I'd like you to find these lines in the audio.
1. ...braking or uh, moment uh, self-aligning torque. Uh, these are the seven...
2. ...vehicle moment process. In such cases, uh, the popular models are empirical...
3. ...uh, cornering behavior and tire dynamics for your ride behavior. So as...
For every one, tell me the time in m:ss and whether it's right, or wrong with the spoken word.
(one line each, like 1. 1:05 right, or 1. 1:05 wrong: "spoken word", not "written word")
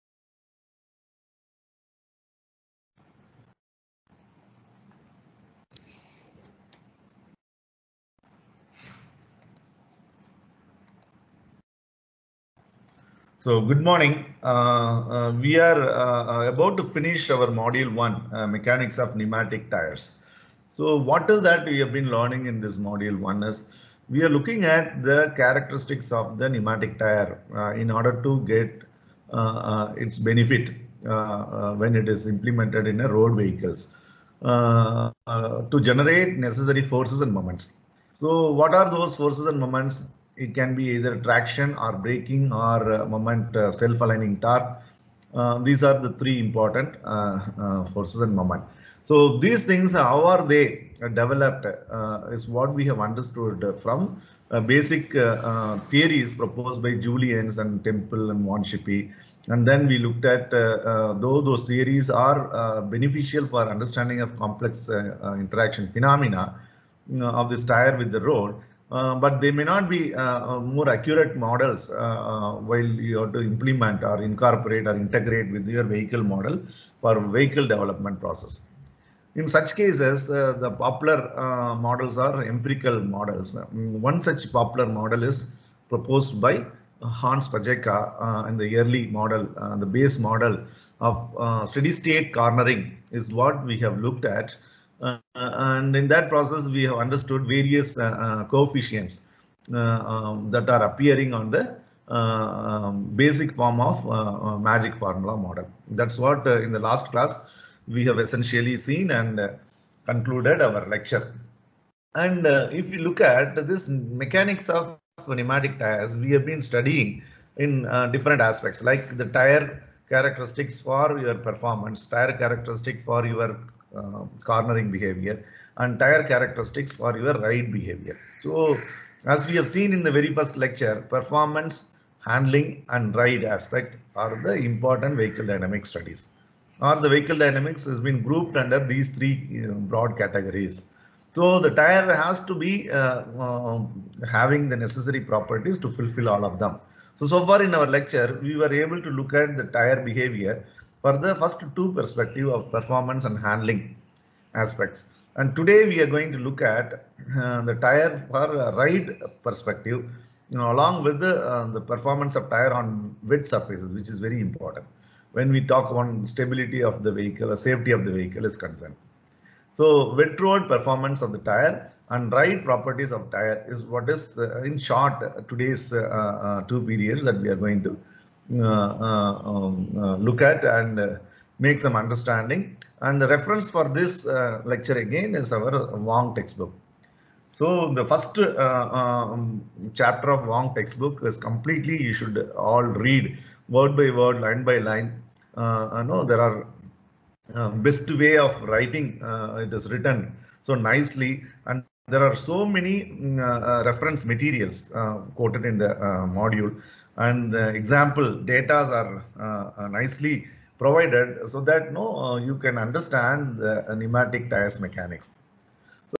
1. 0:42 wrong: "three", not "seven"
2. 1:17 wrong: "development", not "moment"
3. 2:03 wrong: "characteristics", not "dynamics".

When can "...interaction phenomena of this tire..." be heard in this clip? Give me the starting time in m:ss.
1:04.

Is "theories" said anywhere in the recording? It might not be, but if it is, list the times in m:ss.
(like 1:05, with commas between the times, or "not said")
0:55, 1:01.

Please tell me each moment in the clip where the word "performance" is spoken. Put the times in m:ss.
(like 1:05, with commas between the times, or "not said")
2:01, 2:11, 2:32, 2:41, 2:50.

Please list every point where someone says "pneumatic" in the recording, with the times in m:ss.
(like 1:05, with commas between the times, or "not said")
0:19, 0:26, 1:55, 3:34.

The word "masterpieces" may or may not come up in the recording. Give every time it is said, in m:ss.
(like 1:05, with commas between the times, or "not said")
not said.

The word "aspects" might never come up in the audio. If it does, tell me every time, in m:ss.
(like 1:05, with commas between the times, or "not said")
1:58, 2:13, 2:34.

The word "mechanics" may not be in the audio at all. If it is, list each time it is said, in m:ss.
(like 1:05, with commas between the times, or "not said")
0:18, 1:53, 3:34.